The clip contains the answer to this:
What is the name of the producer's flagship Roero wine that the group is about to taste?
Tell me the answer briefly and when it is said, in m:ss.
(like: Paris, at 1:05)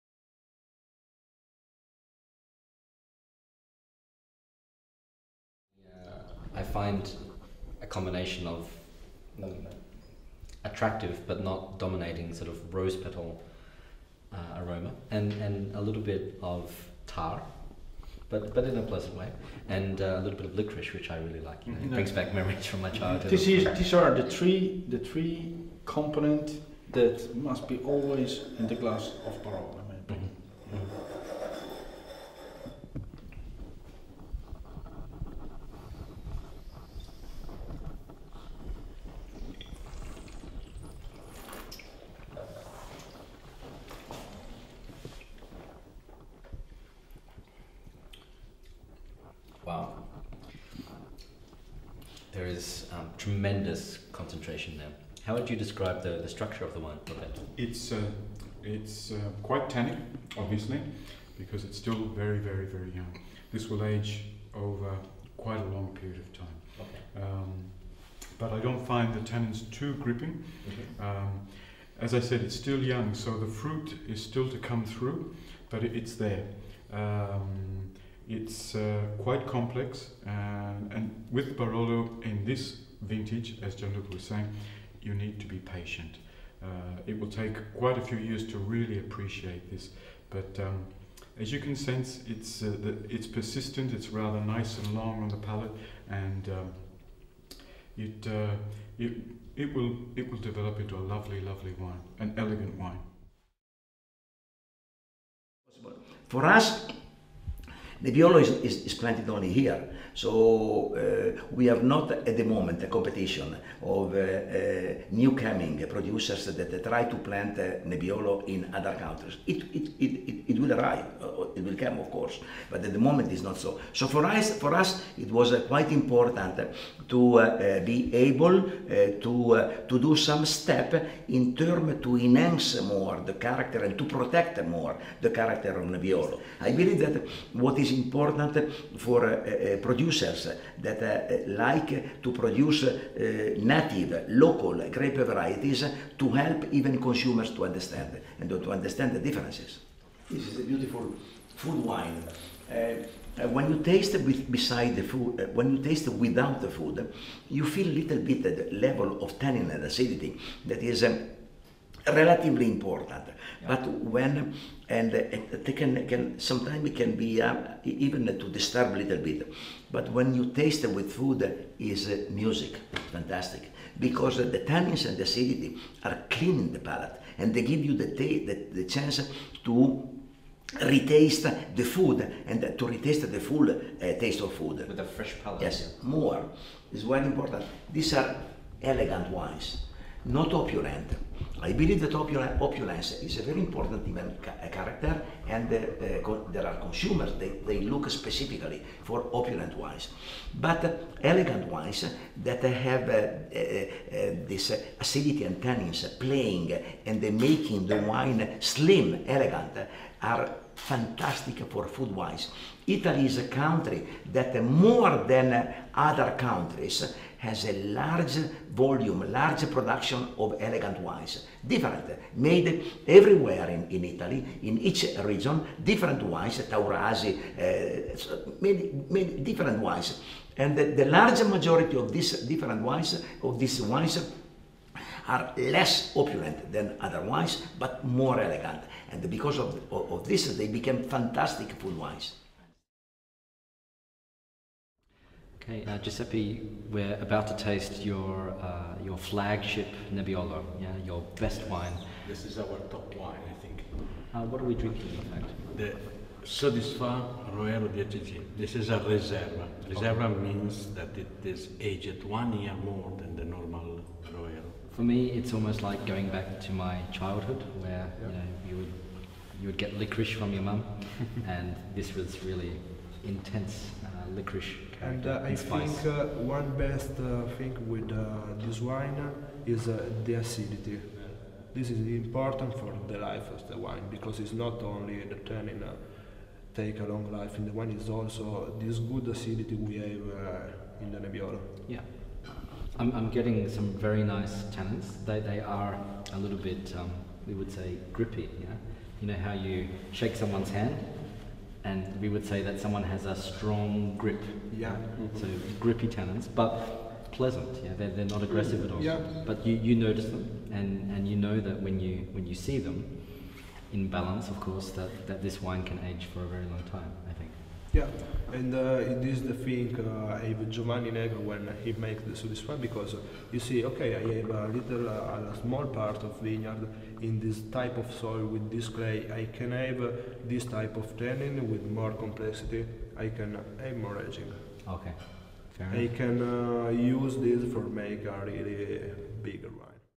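Sudisfà, at 4:16.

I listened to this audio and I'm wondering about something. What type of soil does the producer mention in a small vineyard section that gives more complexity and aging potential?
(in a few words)
Clay.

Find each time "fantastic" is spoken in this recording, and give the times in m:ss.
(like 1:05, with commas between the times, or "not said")
2:53, 3:30, 4:01.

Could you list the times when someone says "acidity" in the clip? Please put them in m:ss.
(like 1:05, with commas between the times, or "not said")
2:39, 2:55, 3:24, 4:40, 4:49.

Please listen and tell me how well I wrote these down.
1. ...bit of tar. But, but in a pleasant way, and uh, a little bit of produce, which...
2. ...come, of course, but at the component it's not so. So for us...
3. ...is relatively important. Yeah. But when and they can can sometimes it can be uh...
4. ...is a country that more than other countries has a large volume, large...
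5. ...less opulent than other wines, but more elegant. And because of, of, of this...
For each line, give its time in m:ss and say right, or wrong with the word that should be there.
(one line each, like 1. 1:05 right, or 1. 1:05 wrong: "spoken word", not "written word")
1. 0:16 wrong: "licorice", not "produce"
2. 2:01 wrong: "moment", not "component"
3. 2:40 right
4. 3:33 right
5. 3:55 right.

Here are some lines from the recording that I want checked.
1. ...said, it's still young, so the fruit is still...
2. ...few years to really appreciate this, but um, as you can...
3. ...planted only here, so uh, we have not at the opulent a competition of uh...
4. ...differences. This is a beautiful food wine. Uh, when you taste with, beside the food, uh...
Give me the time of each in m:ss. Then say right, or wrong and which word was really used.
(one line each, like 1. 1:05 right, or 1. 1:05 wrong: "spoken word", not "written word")
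1. 1:12 right
2. 1:28 right
3. 1:48 wrong: "moment", not "opulent"
4. 2:29 right.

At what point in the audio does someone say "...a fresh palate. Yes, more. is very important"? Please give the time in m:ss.
3:04.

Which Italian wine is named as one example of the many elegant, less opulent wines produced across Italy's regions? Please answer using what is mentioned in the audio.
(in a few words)
Taurasi.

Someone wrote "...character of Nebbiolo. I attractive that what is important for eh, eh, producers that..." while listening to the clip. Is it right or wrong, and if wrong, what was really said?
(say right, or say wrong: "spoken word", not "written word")
wrong: "believe", not "attractive".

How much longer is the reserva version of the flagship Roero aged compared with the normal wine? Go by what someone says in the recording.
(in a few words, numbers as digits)
One year.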